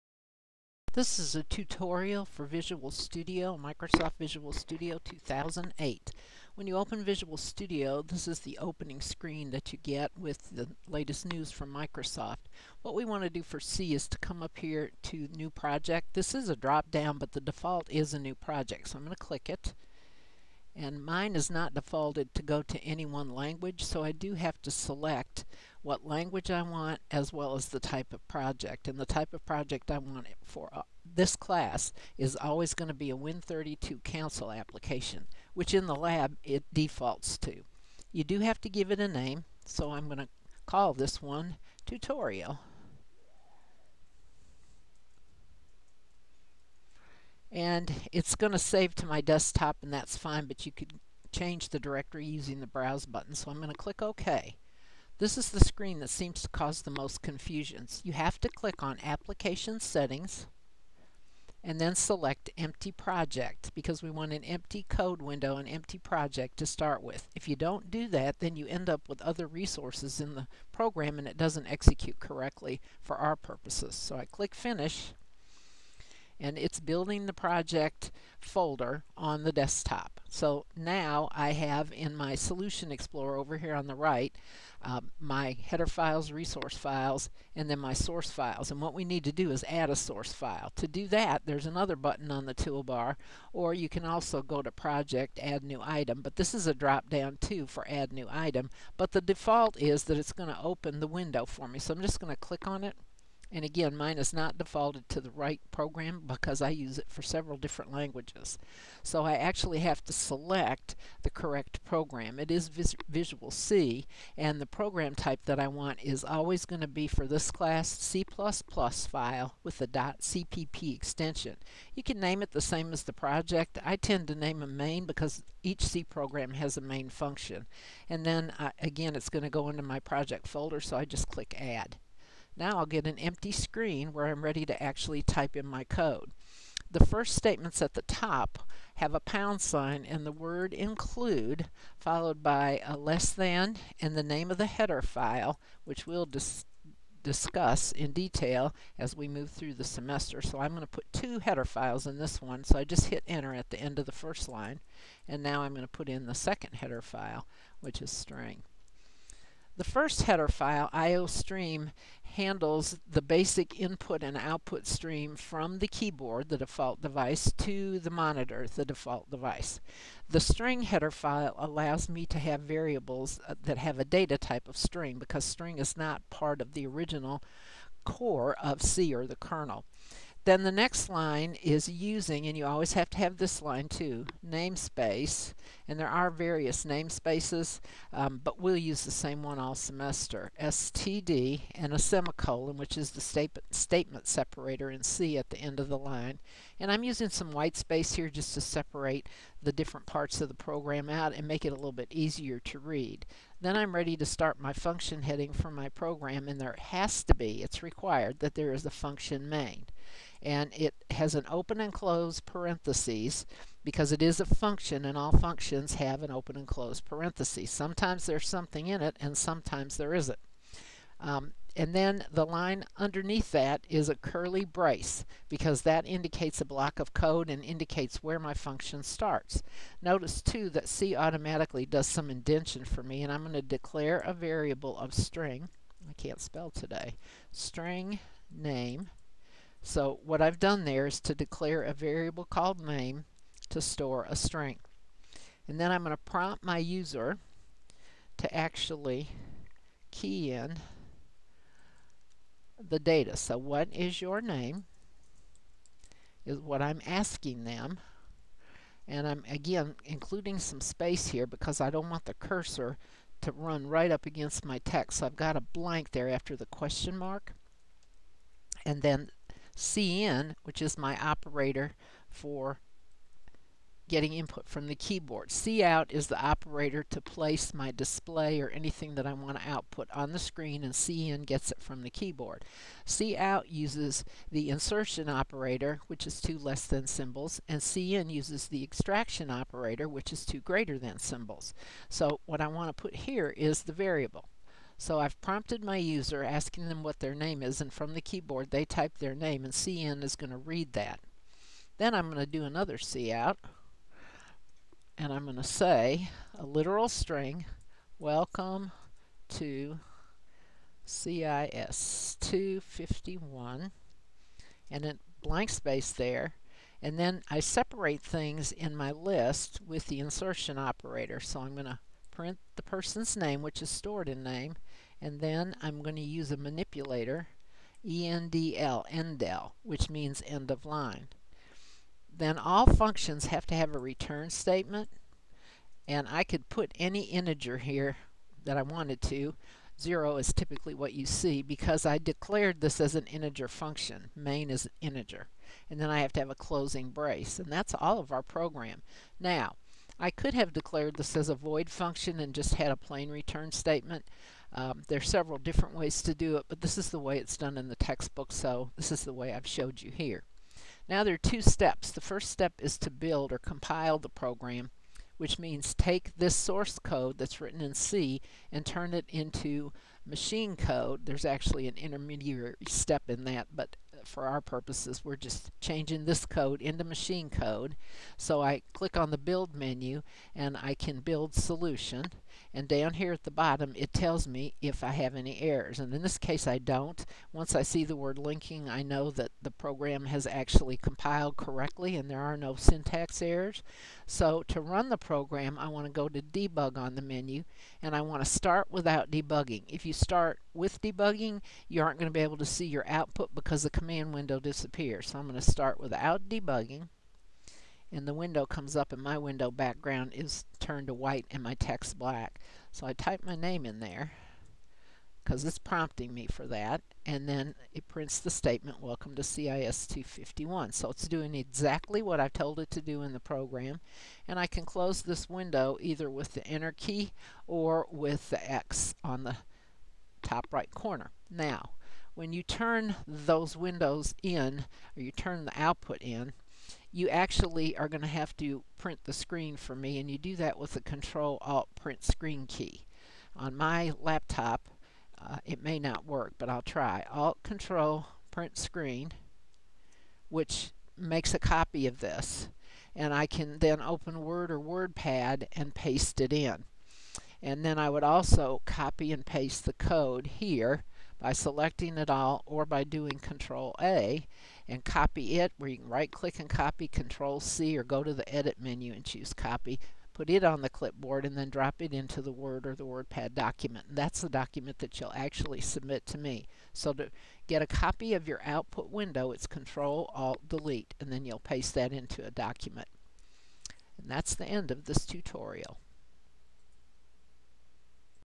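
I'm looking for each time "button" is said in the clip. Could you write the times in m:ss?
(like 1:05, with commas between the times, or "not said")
0:53, 1:31.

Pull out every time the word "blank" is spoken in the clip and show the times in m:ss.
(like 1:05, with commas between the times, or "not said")
4:25, 5:15.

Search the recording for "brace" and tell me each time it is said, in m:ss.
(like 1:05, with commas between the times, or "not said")
3:44, 5:47.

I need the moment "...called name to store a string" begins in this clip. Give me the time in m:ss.
4:02.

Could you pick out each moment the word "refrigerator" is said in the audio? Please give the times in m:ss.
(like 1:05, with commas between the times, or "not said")
not said.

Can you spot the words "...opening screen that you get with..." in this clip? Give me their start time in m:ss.
0:08.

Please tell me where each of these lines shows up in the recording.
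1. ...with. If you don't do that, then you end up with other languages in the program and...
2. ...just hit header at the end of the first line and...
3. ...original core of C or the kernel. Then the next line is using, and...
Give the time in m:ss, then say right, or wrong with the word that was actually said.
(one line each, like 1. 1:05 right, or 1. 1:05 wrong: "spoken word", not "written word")
1. 1:07 wrong: "resources", not "languages"
2. 2:32 wrong: "enter", not "header"
3. 2:56 right.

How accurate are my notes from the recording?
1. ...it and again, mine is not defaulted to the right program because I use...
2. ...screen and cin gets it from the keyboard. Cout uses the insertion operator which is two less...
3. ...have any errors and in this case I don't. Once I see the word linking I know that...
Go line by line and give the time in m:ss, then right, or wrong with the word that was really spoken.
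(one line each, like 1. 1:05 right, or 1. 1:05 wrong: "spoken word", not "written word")
1. 1:42 right
2. 4:40 right
3. 6:25 right.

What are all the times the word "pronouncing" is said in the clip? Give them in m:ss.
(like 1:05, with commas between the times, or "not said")
not said.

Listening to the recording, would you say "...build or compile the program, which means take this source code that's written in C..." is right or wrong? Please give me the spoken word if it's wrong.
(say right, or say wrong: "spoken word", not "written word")
right.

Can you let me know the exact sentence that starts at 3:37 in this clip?
Sometimes there's something in it and sometimes there isn't.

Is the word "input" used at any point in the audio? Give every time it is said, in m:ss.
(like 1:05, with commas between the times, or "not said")
2:43, 4:34.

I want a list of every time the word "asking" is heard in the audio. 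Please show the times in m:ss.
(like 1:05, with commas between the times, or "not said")
4:17, 4:56.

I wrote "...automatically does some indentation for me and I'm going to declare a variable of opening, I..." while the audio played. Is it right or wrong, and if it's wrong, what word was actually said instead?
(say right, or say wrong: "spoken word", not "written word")
wrong: "string", not "opening".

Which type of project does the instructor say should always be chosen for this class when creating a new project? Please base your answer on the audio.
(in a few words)
Win32 Console application.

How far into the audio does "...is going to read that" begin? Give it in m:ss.
5:00.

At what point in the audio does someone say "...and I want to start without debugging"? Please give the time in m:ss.
6:38.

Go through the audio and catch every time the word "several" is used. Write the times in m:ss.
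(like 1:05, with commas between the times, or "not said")
1:47, 5:55.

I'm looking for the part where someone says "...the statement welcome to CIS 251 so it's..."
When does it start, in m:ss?
6:58.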